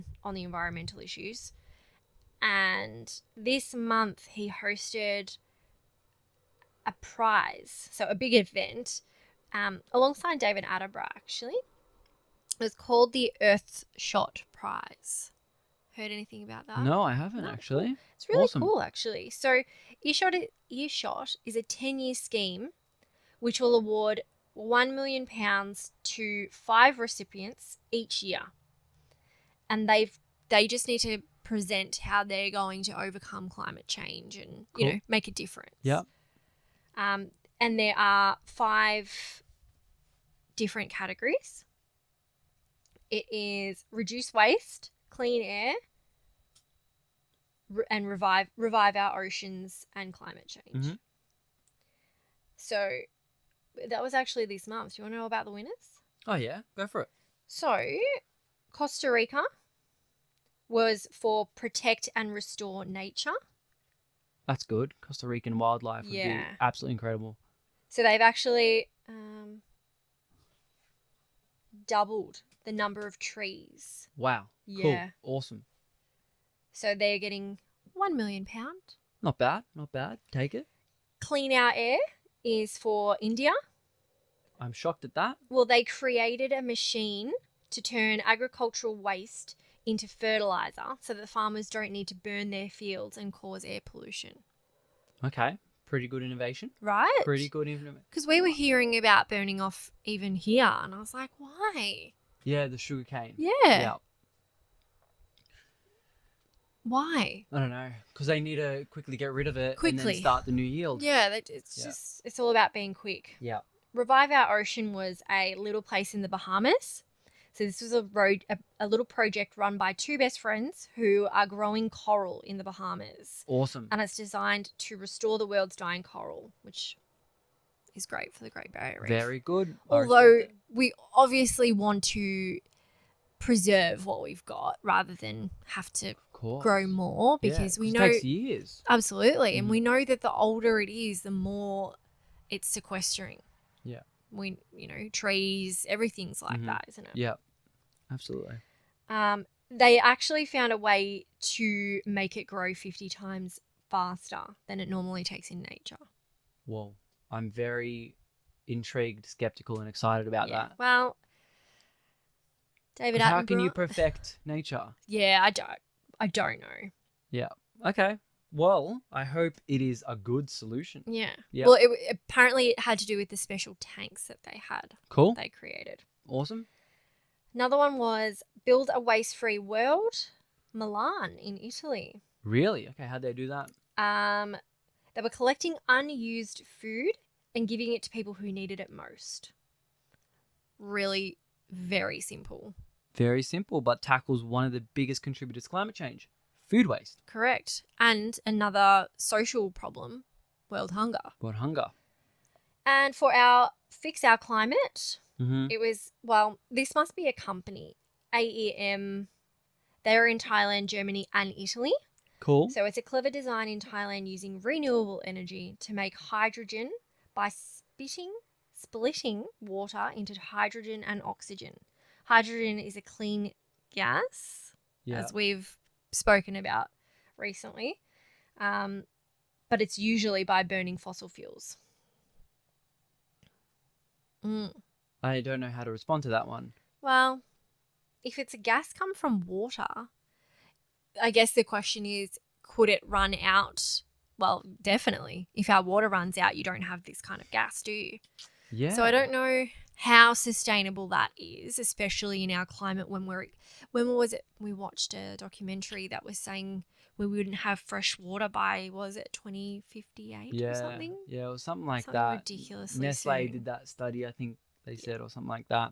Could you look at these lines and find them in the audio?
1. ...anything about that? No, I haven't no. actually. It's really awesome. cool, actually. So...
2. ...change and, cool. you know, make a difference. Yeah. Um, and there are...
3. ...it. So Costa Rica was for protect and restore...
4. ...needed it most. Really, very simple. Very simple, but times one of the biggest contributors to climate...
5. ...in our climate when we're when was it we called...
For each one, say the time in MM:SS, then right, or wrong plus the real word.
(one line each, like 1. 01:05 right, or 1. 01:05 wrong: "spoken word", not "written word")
1. 00:16 right
2. 00:33 right
3. 00:57 right
4. 03:08 wrong: "tackles", not "times"
5. 04:12 wrong: "watched", not "called".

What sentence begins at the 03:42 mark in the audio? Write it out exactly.
Hydrogen is a clean gas, yeah.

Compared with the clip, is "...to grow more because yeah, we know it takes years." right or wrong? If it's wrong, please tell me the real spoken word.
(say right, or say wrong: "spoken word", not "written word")
right.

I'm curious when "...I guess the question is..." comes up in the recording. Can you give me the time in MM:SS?
04:01.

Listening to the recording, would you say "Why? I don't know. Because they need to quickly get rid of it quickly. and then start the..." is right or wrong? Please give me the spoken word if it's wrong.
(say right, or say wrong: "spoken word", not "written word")
right.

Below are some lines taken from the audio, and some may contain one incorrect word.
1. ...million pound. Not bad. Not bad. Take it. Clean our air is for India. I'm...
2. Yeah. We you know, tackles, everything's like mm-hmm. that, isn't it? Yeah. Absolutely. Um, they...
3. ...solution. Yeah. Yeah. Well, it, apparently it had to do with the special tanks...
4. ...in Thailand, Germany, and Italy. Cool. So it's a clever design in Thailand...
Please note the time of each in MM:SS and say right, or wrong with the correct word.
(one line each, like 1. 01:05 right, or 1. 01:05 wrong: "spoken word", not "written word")
1. 01:18 right
2. 02:23 wrong: "trees", not "tackles"
3. 02:50 right
4. 03:30 right.